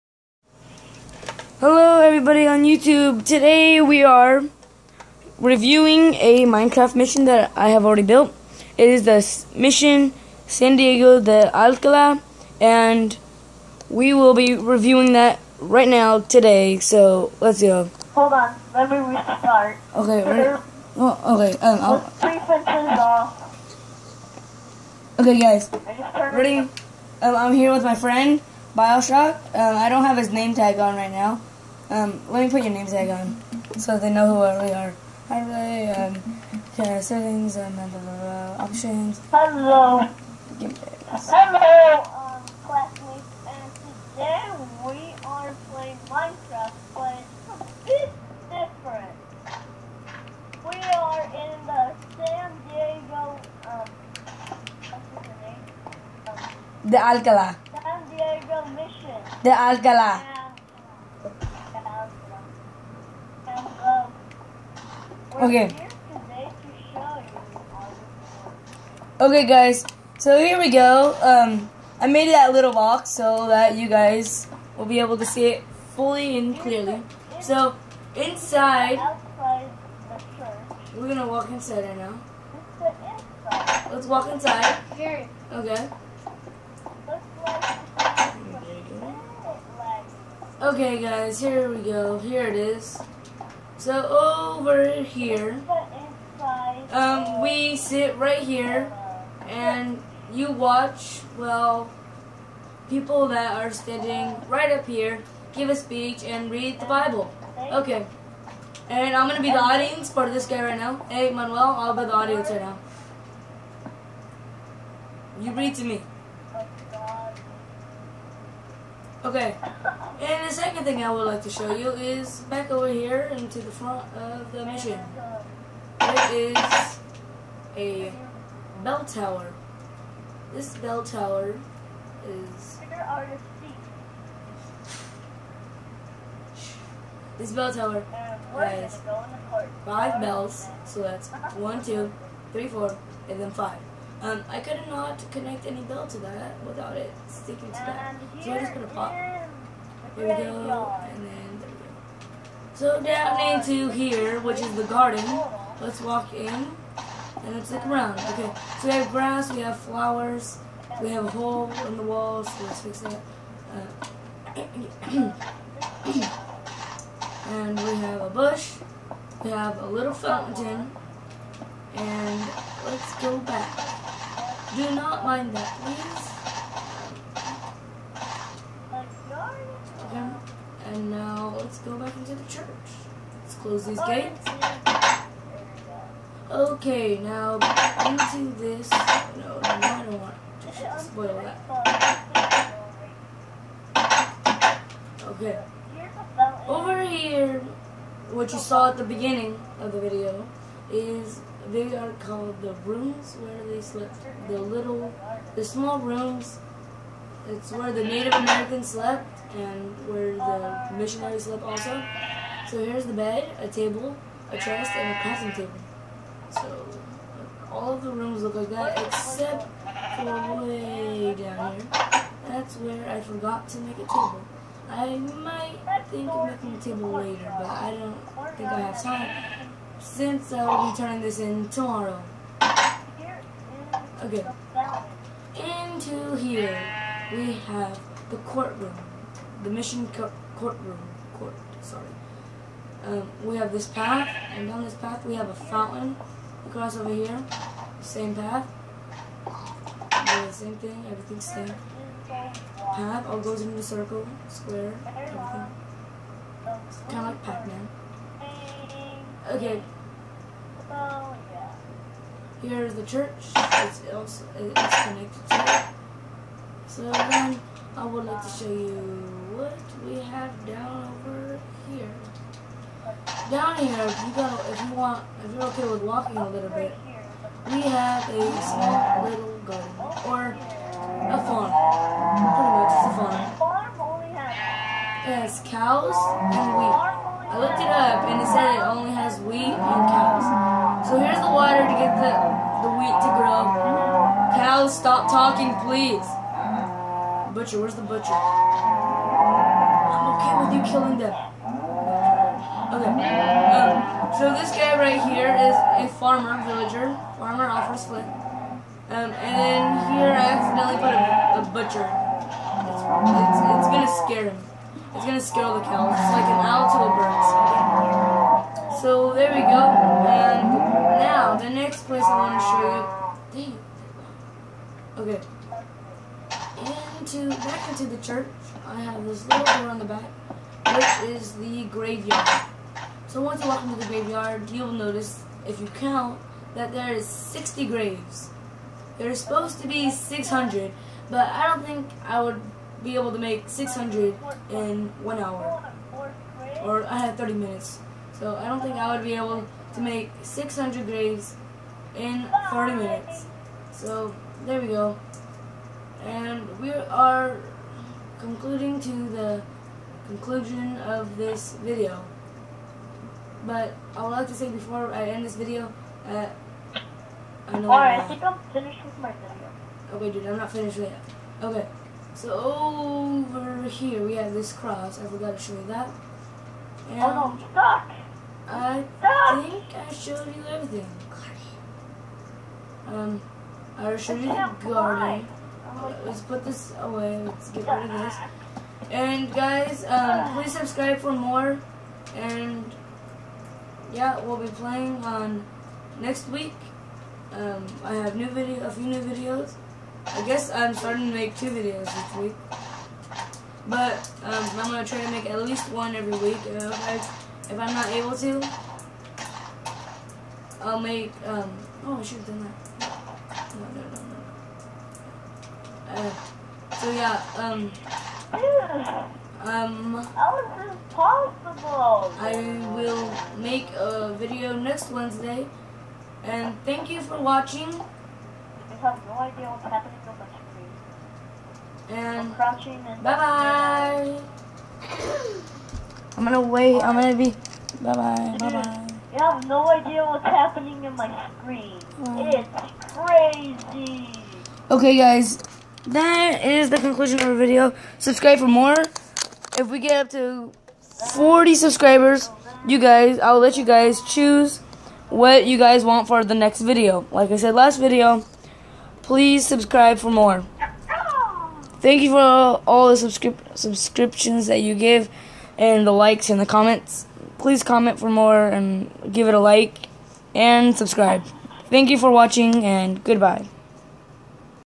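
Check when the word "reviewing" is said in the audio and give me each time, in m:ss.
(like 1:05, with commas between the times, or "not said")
0:05, 0:14.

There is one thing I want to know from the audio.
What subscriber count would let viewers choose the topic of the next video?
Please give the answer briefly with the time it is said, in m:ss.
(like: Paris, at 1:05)
40, at 7:31.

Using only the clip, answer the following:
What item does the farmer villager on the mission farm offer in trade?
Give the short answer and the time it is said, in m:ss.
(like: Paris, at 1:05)
Flint, at 5:07.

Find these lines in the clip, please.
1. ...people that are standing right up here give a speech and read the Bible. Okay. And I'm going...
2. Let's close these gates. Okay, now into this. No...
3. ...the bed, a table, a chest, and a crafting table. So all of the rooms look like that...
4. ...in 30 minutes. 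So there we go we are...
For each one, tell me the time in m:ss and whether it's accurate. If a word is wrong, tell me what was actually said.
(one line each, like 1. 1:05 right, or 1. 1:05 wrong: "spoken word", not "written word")
1. 1:42 right
2. 3:03 right
3. 3:33 right
4. 5:52 right.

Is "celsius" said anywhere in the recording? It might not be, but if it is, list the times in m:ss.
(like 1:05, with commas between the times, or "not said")
not said.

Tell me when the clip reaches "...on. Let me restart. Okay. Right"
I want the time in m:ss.
0:18.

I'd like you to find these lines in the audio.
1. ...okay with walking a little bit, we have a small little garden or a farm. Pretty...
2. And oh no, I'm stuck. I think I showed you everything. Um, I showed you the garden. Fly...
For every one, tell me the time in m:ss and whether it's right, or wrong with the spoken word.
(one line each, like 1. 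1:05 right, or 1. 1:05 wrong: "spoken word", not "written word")
1. 4:35 right
2. 6:17 right.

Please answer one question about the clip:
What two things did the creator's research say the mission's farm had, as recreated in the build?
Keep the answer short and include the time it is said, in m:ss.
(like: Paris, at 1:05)
Wheat and cows, at 4:49.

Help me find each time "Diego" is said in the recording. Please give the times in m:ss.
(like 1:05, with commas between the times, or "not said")
0:10, 0:52, 0:58.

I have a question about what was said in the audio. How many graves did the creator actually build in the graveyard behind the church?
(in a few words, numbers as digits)
60.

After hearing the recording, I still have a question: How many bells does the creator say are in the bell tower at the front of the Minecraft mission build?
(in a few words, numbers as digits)
5.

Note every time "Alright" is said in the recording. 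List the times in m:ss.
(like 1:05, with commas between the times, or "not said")
6:07.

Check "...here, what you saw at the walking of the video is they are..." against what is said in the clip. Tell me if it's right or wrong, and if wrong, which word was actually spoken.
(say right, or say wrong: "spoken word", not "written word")
wrong: "beginning", not "walking".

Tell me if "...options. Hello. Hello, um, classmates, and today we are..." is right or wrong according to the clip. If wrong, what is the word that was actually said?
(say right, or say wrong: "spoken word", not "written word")
right.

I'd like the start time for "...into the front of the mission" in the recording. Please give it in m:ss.
2:03.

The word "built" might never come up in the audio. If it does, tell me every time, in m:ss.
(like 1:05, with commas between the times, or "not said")
0:08.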